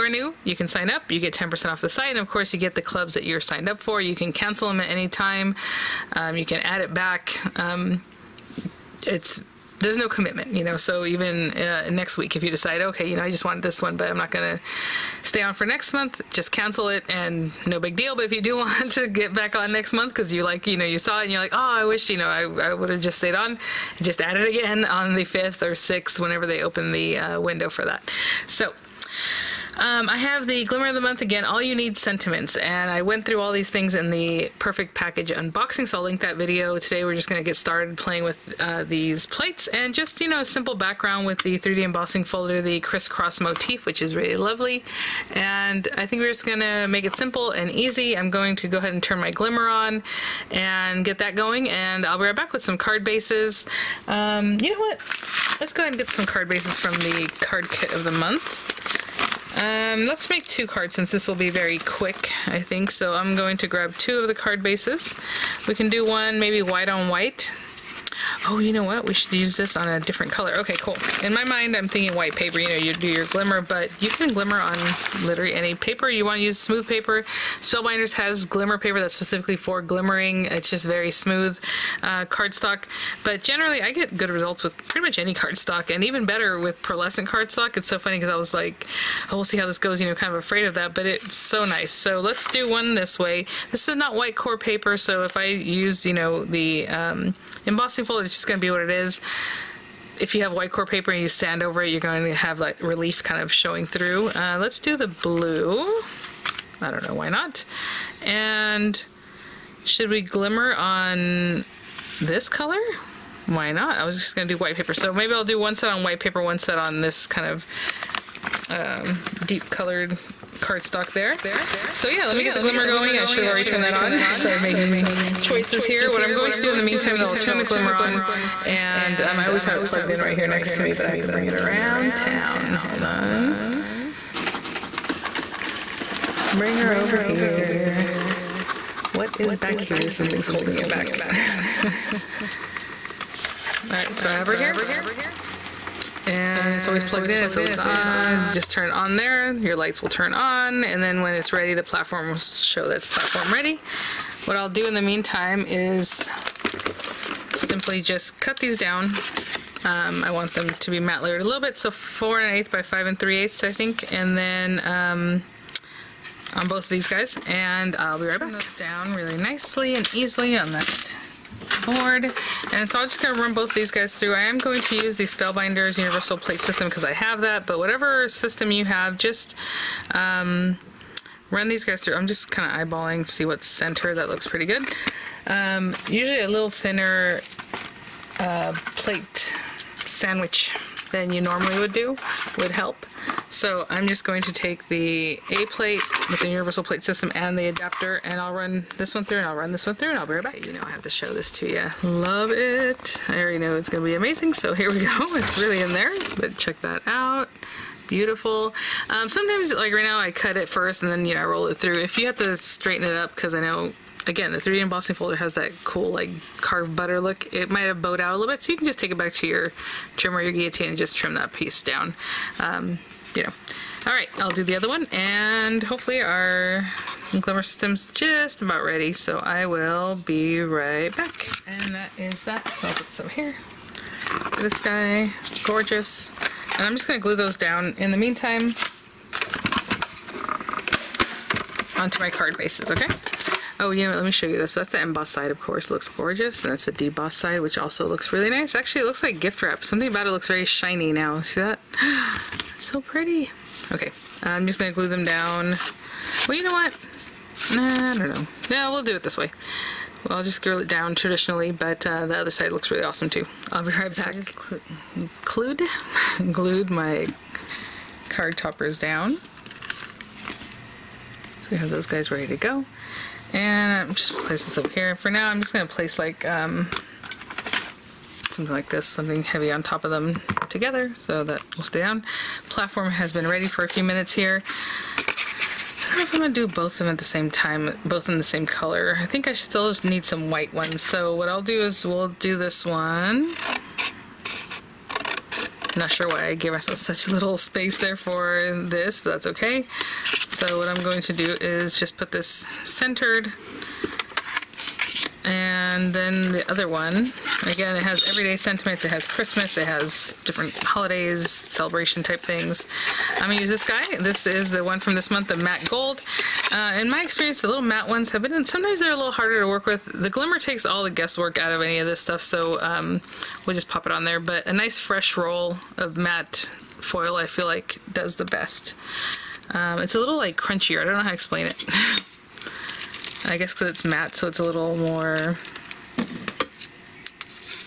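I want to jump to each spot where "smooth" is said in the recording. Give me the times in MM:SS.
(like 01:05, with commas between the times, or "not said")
01:16, 01:21.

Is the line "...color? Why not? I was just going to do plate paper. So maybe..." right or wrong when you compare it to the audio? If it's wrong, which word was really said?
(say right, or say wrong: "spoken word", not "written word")
wrong: "white", not "plate".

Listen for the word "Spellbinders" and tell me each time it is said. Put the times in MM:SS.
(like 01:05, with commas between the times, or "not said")
01:17, 02:55.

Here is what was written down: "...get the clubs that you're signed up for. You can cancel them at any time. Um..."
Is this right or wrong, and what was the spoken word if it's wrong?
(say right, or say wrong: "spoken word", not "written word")
right.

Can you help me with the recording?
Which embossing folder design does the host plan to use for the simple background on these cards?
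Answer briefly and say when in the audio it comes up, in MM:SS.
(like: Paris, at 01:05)
crisscross motif, at 00:42.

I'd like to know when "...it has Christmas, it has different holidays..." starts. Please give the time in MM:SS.
05:09.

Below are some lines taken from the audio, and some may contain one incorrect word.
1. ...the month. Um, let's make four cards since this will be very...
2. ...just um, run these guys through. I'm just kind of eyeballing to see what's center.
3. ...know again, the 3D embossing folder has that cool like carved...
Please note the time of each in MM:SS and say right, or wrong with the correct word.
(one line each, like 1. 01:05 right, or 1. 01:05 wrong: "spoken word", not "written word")
1. 00:58 wrong: "two", not "four"
2. 02:59 right
3. 03:33 right.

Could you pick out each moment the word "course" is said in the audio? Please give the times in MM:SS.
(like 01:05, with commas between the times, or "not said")
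00:02, 04:05.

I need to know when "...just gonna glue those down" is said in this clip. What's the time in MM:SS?
03:56.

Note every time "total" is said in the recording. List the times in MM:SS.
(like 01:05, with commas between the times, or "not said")
not said.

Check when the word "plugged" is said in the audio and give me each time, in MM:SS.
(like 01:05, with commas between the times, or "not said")
02:09, 02:27.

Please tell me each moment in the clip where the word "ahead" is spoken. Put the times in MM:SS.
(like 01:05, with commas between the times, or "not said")
00:48, 00:55.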